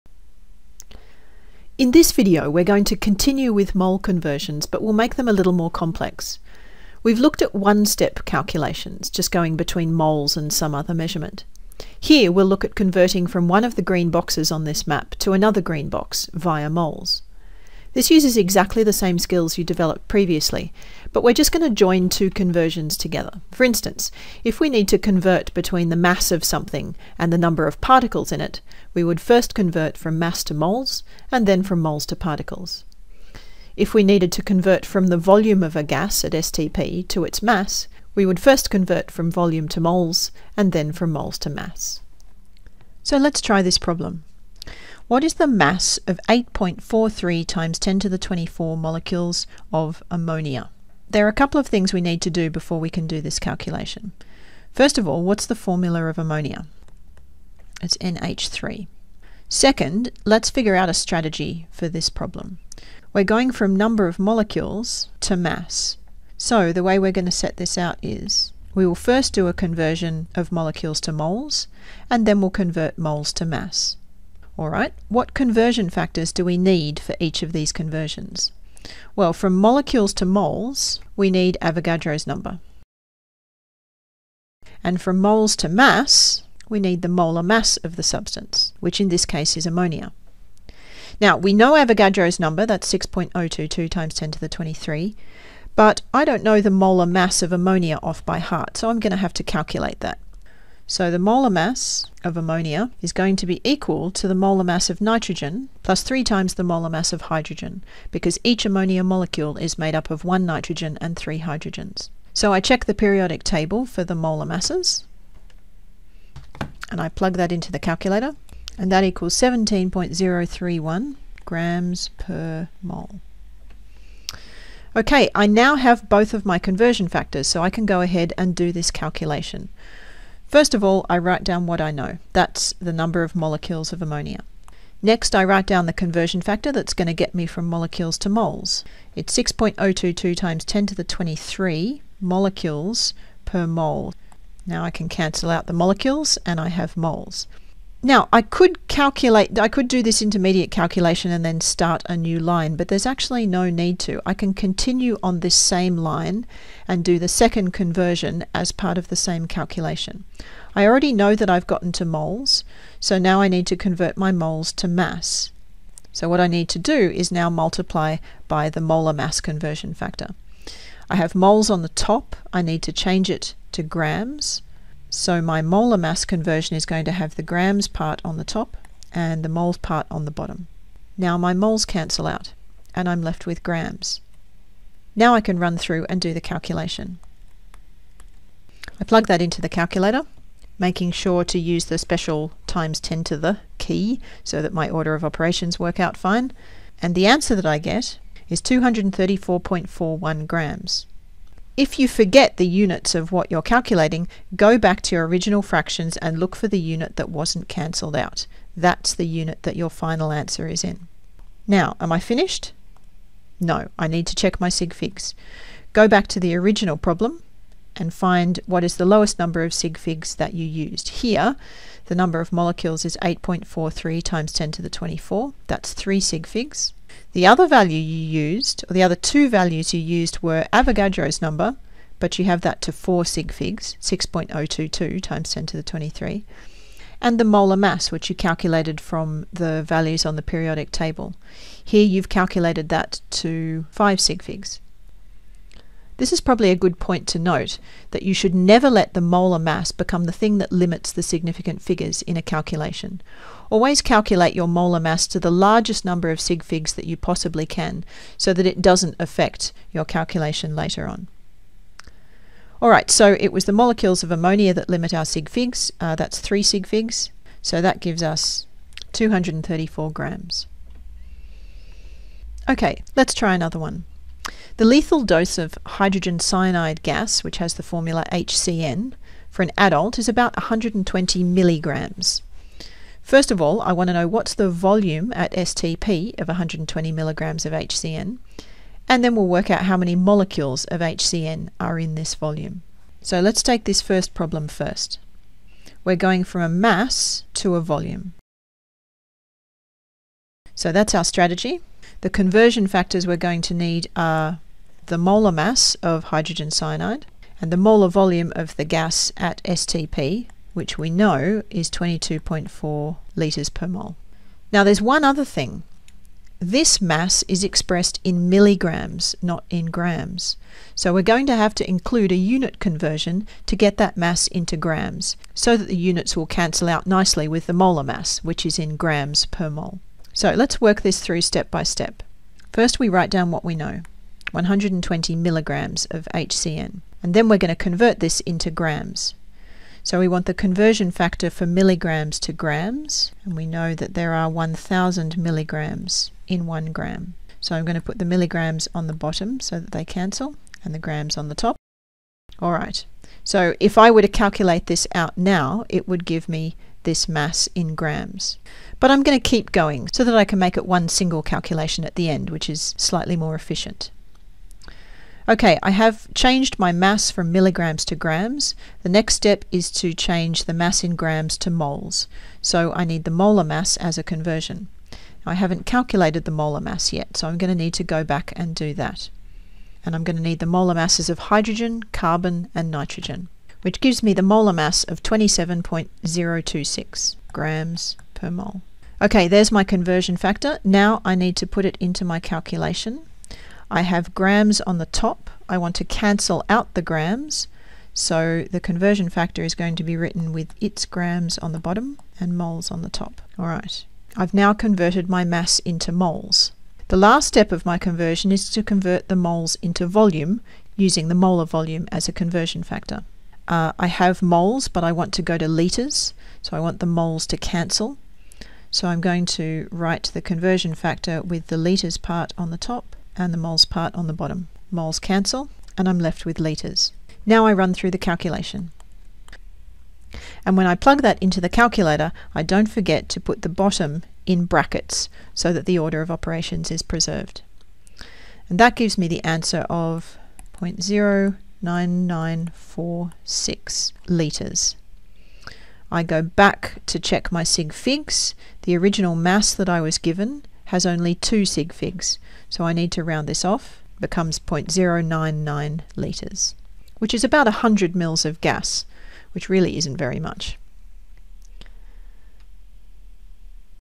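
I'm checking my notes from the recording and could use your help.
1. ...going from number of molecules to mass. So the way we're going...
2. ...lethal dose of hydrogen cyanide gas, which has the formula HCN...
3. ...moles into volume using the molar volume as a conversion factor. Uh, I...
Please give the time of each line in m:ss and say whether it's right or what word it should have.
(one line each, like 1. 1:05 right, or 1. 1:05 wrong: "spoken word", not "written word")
1. 1:03 right
2. 4:34 right
3. 6:49 right.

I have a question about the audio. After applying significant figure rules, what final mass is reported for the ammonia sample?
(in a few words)
234 grams.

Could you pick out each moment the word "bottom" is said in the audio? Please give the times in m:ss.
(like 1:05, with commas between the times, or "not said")
3:00, 5:49, 6:41, 7:04, 7:13.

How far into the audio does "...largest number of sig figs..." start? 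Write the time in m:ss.
4:15.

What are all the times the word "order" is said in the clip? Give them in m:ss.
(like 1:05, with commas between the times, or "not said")
3:14, 7:15.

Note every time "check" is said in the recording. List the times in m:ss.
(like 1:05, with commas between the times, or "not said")
1:52, 3:34, 7:27.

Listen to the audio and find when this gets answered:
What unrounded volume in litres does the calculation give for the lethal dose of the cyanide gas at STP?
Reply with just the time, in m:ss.
7:20.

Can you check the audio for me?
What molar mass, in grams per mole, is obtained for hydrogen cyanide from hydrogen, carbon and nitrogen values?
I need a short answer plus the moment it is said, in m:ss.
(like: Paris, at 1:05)
27.026, at 6:25.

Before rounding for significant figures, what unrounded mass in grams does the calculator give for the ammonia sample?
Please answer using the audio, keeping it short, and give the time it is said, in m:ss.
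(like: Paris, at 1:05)
234.41 grams, at 3:18.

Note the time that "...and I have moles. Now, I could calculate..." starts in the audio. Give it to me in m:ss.
2:26.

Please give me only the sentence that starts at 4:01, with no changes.
Here you've calculated that to 5 sig figs.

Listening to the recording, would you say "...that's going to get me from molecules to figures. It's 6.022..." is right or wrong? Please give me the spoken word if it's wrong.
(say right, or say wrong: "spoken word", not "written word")
wrong: "moles", not "figures".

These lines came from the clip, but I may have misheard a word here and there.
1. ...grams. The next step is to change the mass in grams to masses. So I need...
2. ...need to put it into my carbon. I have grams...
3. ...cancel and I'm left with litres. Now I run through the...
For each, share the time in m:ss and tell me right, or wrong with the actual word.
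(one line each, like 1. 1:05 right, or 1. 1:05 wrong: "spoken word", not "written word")
1. 6:08 wrong: "moles", not "masses"
2. 6:31 wrong: "calculation", not "carbon"
3. 7:05 right.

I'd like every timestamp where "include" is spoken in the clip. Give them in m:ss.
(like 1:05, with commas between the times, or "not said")
5:21.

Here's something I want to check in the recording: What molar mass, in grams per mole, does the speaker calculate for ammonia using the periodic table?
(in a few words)
17.031.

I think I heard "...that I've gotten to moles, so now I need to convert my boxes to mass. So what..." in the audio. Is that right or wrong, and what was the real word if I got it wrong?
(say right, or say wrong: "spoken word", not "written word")
wrong: "moles", not "boxes".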